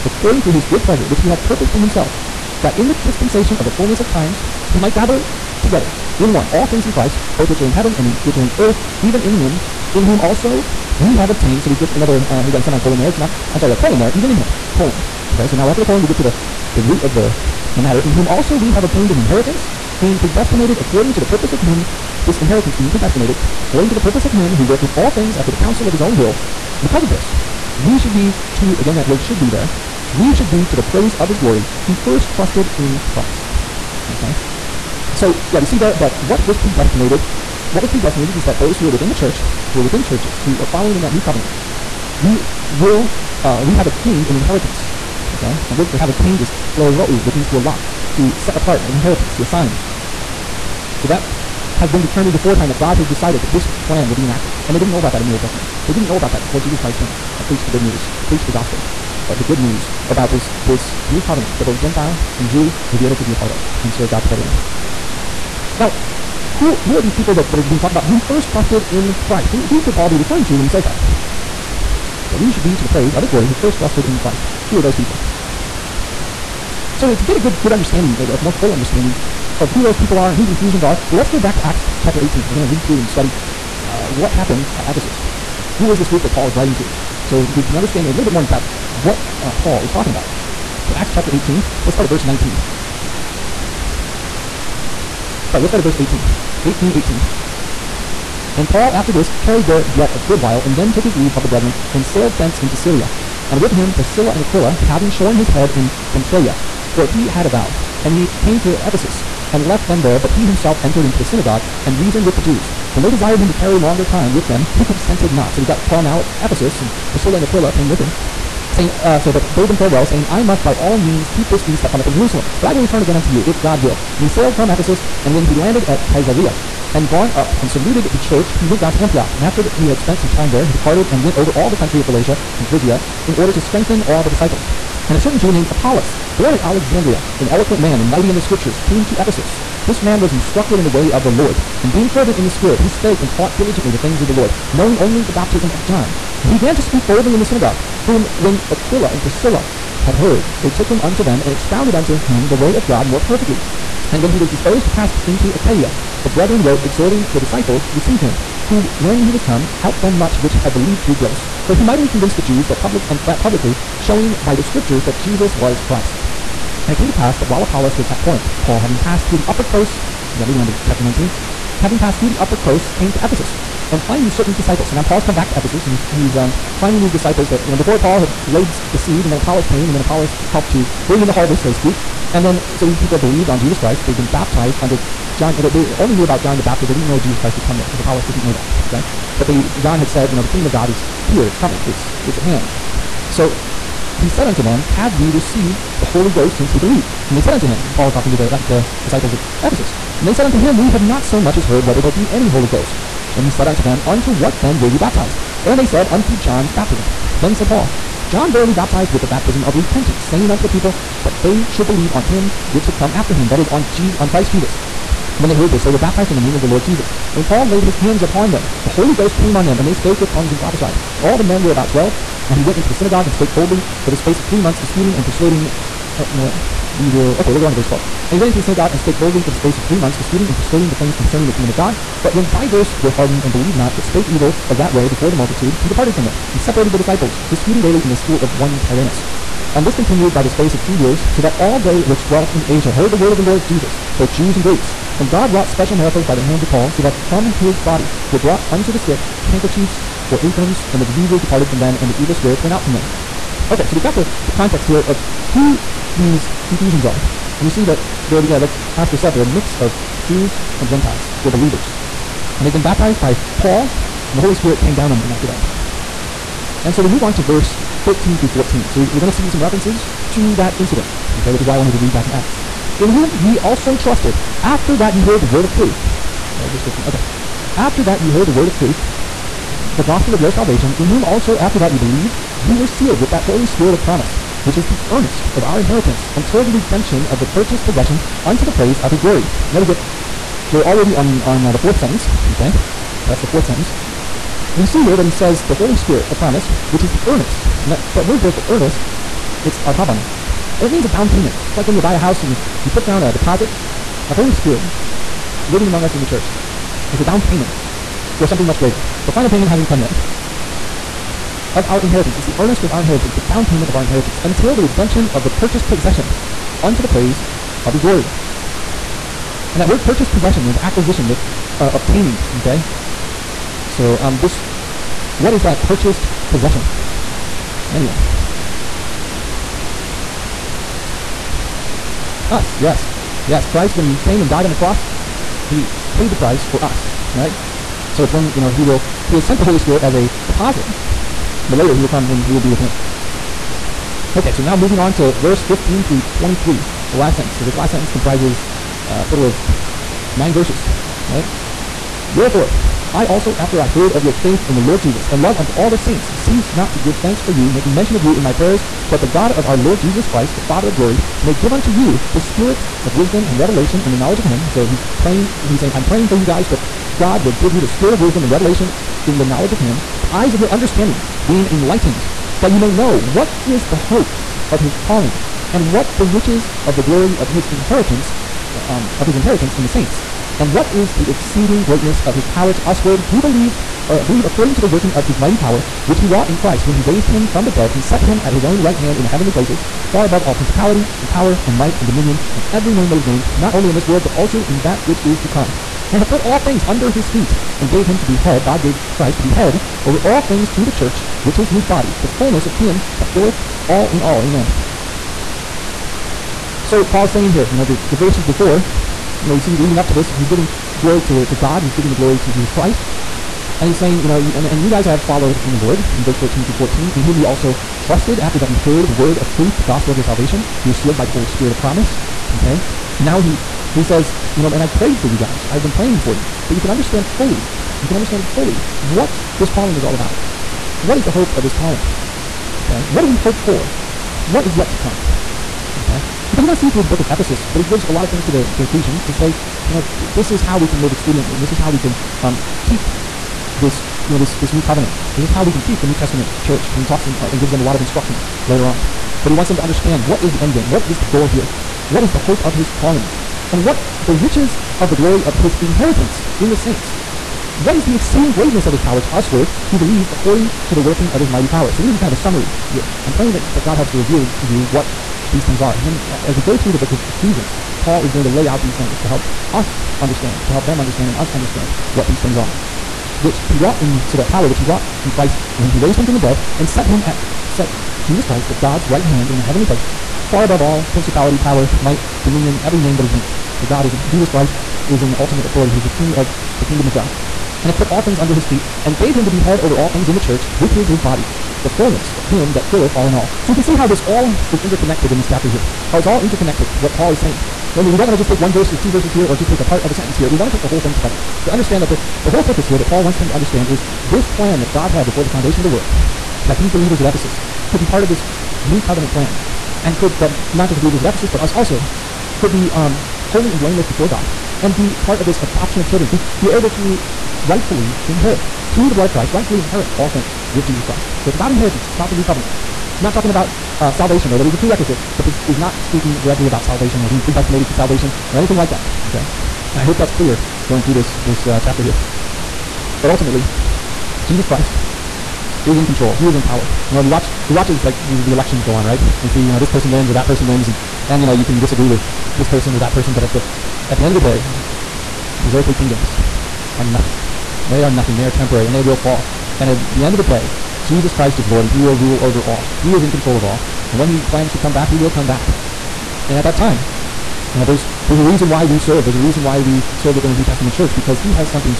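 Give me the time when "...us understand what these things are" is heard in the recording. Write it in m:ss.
7:51.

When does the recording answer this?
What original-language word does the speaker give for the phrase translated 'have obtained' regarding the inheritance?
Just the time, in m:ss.
0:46.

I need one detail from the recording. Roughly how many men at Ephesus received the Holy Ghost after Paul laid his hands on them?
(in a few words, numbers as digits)
12.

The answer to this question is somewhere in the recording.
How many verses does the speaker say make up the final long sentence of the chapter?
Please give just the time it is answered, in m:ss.
5:50.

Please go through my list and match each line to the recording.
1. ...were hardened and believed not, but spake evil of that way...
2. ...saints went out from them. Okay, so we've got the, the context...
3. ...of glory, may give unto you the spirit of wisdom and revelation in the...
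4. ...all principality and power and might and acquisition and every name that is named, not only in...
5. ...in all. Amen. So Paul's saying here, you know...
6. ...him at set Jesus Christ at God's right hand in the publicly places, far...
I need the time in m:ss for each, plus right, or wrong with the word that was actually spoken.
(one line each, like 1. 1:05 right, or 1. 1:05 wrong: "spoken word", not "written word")
1. 3:53 right
2. 4:12 wrong: "spirits", not "saints"
3. 6:00 right
4. 6:30 wrong: "dominion", not "acquisition"
5. 6:44 right
6. 7:57 wrong: "heavenly", not "publicly".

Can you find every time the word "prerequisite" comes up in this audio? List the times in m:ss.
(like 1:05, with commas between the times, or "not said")
8:44.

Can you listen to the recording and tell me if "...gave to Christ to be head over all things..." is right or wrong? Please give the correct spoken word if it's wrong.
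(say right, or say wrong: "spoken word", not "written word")
right.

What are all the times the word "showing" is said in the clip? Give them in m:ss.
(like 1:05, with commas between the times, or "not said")
2:43.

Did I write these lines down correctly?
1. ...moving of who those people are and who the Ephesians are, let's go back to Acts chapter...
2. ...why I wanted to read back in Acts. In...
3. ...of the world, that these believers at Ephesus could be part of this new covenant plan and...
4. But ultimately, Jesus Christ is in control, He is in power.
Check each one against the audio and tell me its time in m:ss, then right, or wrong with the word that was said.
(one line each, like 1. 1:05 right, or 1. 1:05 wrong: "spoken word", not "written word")
1. 1:18 wrong: "understanding", not "moving"
2. 4:31 right
3. 8:25 right
4. 8:53 right.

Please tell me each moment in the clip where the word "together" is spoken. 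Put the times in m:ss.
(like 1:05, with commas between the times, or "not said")
0:05, 1:04, 8:21.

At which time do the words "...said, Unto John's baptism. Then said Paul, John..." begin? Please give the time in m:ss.
3:25.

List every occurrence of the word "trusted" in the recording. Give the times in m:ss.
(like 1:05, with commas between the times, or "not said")
0:32, 1:08, 1:13, 4:33, 6:57.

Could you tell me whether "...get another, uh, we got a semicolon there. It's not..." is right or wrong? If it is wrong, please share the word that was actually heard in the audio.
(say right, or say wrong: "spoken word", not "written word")
right.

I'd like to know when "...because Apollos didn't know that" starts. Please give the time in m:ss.
3:07.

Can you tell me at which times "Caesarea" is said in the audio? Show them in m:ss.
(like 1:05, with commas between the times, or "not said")
2:06.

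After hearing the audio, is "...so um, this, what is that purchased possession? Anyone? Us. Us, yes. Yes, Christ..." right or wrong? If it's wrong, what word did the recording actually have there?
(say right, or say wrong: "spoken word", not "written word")
right.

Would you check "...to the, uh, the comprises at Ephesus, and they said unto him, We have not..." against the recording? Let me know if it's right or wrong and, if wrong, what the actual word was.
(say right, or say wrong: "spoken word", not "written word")
wrong: "disciples", not "comprises".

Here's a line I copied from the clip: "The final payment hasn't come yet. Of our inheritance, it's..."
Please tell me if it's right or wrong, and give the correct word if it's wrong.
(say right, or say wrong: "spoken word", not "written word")
right.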